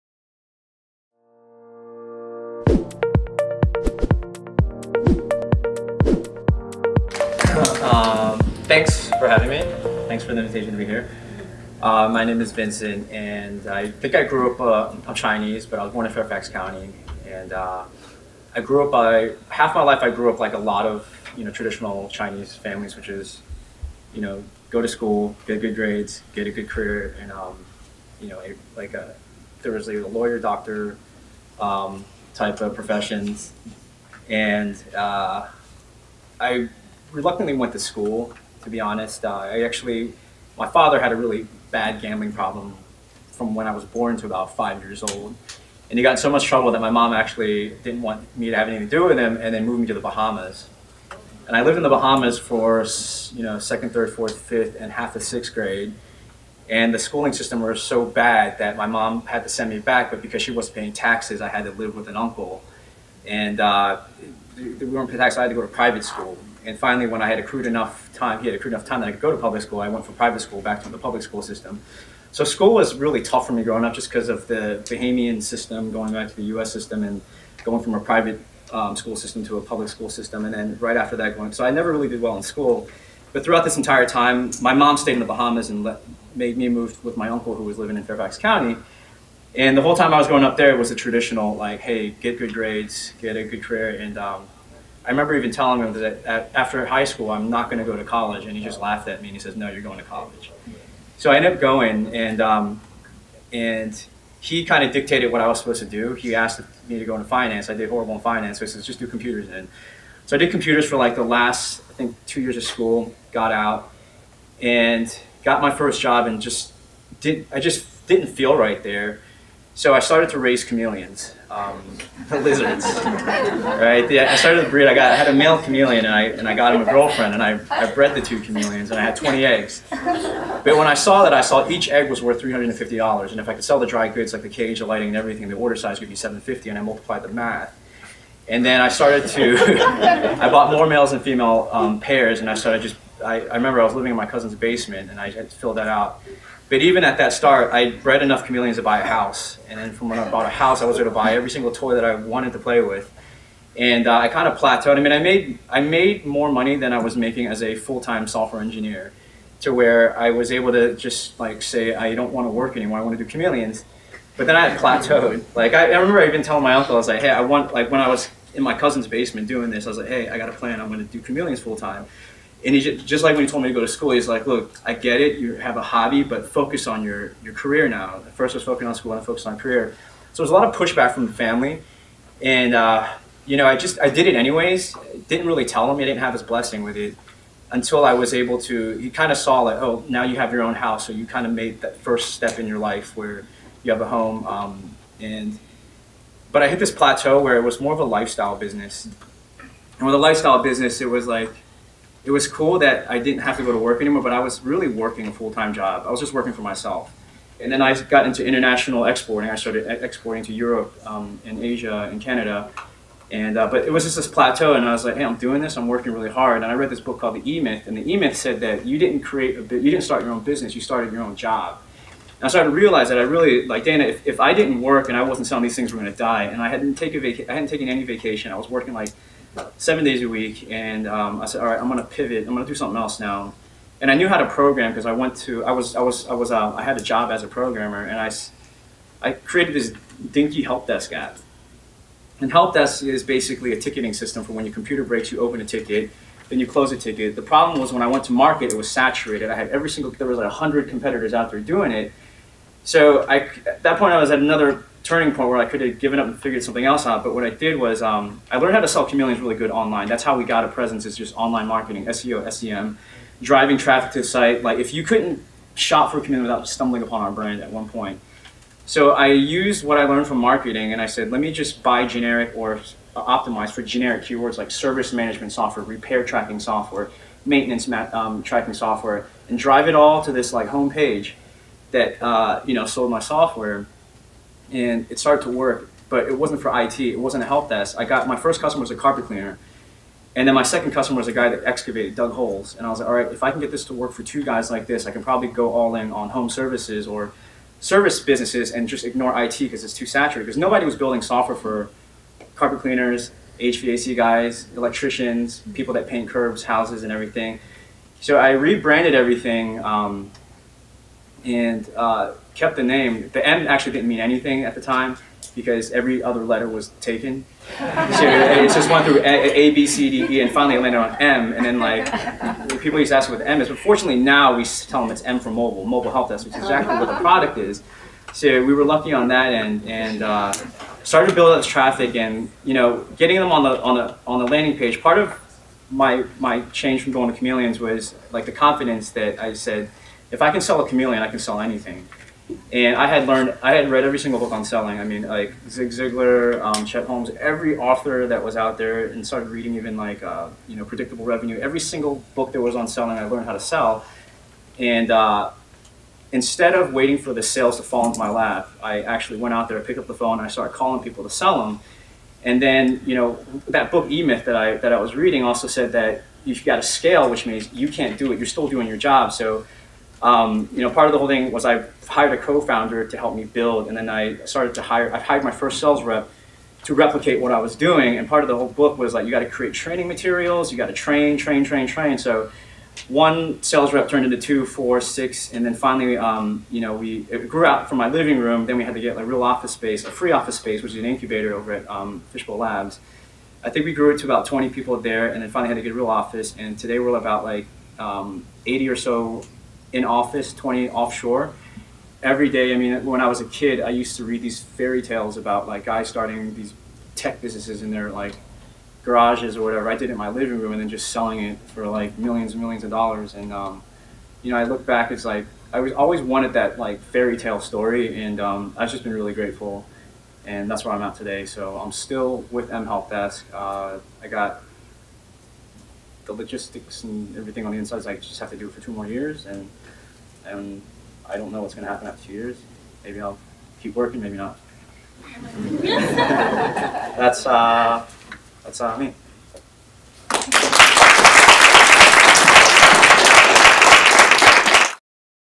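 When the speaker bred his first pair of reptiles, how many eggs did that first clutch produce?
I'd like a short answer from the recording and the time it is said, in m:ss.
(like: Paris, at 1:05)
20, at 2:09.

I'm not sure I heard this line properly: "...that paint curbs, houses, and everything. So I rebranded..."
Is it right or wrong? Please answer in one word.
right.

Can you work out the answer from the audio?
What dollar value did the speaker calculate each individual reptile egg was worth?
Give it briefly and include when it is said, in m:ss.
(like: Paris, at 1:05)
$350, at 2:12.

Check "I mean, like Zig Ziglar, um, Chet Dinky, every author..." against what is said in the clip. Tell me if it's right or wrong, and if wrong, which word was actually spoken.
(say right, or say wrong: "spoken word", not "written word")
wrong: "Holmes", not "Dinky".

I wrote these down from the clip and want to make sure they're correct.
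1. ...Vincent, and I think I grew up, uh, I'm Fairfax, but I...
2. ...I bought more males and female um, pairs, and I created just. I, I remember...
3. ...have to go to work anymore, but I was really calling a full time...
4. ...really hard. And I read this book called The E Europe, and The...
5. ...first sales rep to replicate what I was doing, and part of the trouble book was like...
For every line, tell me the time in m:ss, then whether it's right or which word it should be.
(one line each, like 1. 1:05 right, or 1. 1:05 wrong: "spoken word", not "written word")
1. 0:12 wrong: "Chinese", not "Fairfax"
2. 2:20 wrong: "started", not "created"
3. 3:23 wrong: "working", not "calling"
4. 3:36 wrong: "Myth", not "Europe"
5. 6:15 wrong: "whole", not "trouble".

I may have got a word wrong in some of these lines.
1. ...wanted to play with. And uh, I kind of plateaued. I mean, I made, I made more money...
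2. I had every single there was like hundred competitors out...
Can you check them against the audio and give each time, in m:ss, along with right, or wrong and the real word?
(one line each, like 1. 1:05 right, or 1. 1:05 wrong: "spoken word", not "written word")
1. 2:32 right
2. 4:09 right.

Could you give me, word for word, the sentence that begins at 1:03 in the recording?
And uh, we weren't paying taxes, I had to go to private school.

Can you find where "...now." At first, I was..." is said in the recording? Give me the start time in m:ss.
2:57.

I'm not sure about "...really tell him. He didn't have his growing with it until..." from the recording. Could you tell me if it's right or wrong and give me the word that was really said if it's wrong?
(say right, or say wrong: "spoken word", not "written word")
wrong: "blessing", not "growing".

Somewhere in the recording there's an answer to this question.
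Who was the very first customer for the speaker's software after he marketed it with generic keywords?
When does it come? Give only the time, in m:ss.
4:48.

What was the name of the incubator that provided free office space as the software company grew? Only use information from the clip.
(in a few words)
Fishbowl Labs.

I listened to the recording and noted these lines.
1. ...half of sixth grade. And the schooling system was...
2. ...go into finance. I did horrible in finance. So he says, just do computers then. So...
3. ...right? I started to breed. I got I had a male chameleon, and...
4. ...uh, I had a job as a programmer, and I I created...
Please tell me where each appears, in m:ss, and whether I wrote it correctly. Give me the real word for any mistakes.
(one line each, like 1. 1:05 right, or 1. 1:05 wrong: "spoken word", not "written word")
1. 0:54 right
2. 1:47 right
3. 2:02 right
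4. 3:56 right.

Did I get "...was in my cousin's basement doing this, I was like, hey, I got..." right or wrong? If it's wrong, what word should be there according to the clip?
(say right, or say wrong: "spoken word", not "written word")
right.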